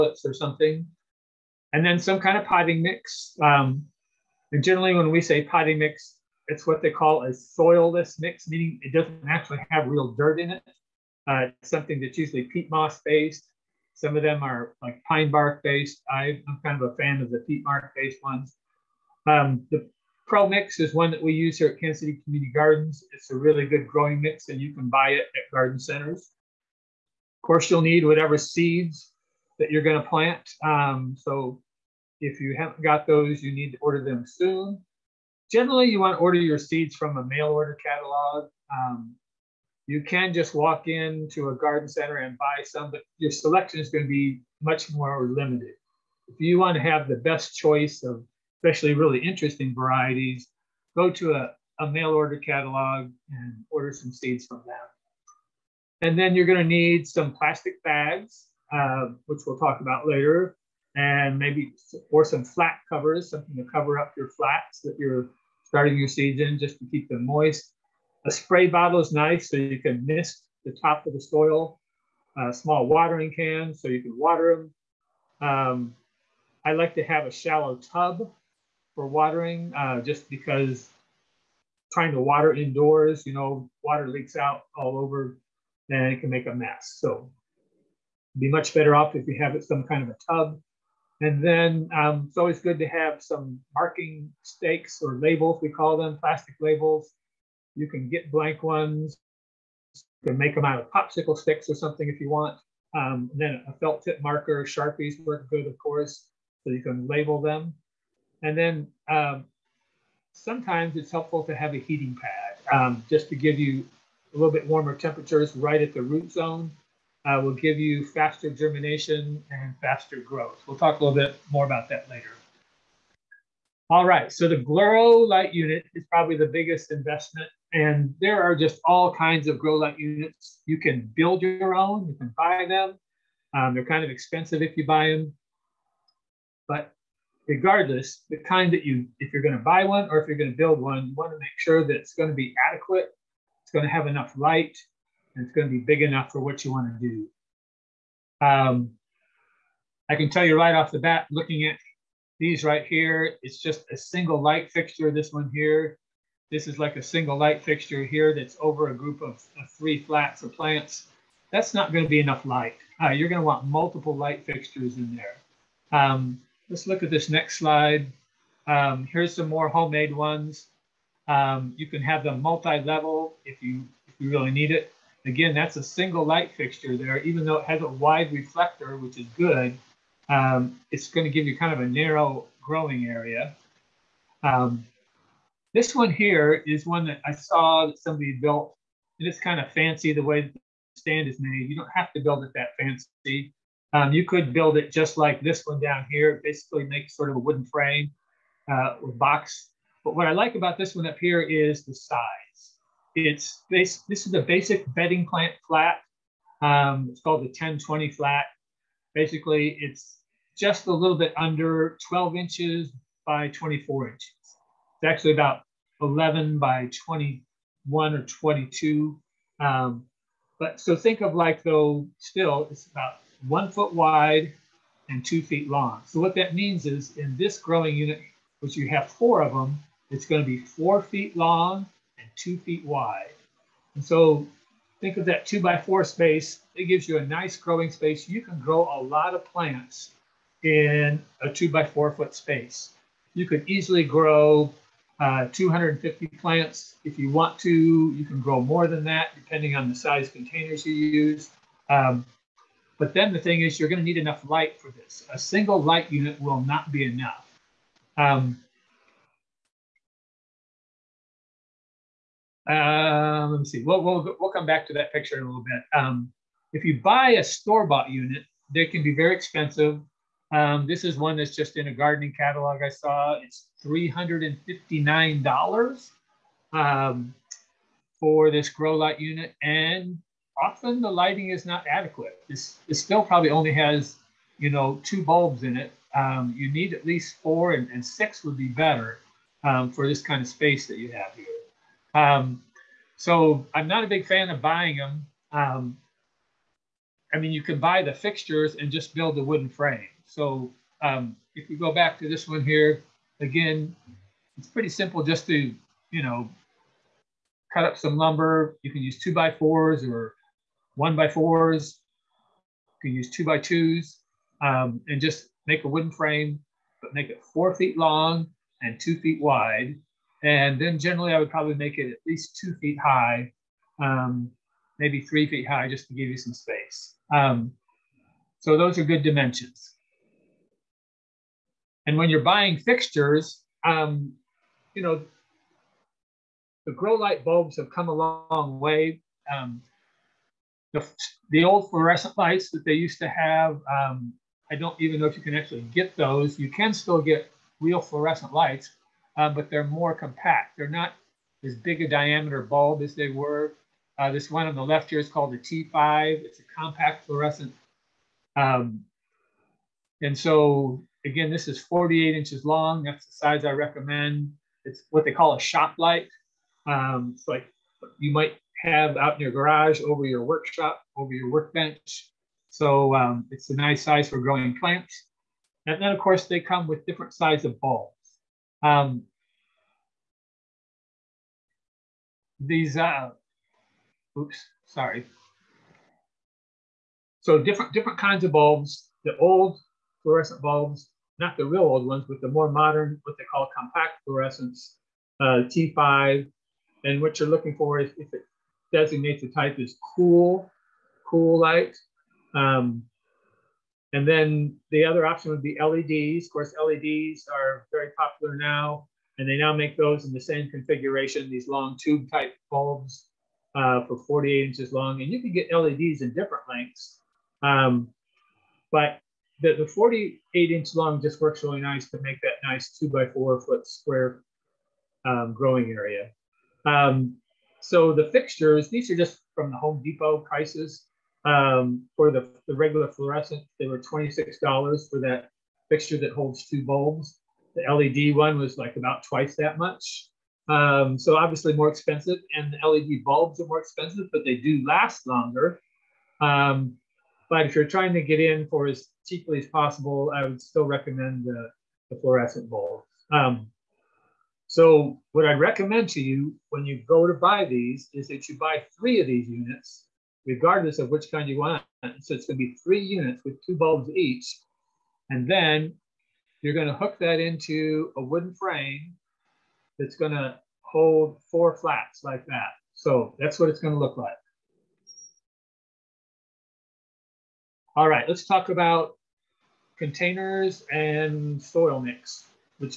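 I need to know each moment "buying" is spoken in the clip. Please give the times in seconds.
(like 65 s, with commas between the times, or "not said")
294 s, 332 s.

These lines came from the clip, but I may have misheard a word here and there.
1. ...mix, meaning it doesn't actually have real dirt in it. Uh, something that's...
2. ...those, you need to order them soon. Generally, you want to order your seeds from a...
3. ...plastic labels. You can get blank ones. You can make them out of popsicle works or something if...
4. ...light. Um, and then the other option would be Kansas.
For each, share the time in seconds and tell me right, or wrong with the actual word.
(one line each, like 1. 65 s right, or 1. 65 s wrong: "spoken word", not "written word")
1. 8 s right
2. 33 s right
3. 96 s wrong: "sticks", not "works"
4. 401 s wrong: "LEDs", not "Kansas".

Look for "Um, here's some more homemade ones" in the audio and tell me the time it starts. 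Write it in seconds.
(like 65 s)
168 s.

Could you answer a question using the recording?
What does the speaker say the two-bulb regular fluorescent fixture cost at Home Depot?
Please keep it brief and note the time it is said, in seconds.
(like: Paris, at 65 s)
$26, at 433 s.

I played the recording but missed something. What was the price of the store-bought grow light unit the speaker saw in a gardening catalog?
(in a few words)
$359.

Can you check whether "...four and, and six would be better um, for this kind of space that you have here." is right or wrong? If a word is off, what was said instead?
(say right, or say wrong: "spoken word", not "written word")
right.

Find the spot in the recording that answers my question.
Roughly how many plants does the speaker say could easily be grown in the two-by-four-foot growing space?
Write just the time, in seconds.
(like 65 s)
245 s.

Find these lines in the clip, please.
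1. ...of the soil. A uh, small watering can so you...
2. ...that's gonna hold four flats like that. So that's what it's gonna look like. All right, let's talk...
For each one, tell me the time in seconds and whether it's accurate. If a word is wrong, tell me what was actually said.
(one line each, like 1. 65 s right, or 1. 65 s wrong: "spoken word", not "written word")
1. 71 s right
2. 469 s right.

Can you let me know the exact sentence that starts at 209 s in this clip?
Basically, it's just a little bit under 12 inches by 24 inches.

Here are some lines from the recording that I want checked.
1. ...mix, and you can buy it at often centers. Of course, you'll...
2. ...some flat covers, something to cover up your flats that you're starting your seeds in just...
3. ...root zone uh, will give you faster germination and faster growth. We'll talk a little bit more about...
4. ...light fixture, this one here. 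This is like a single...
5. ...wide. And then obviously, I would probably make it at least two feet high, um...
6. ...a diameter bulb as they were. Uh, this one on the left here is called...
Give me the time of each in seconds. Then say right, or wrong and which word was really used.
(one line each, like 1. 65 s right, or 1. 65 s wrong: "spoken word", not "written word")
1. 24 s wrong: "garden", not "often"
2. 62 s right
3. 116 s right
4. 154 s right
5. 319 s wrong: "generally", not "obviously"
6. 352 s right.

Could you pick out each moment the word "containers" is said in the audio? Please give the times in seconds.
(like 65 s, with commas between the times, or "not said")
250 s, 479 s.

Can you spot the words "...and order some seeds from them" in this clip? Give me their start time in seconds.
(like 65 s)
53 s.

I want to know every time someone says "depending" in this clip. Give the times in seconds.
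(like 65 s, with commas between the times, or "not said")
249 s.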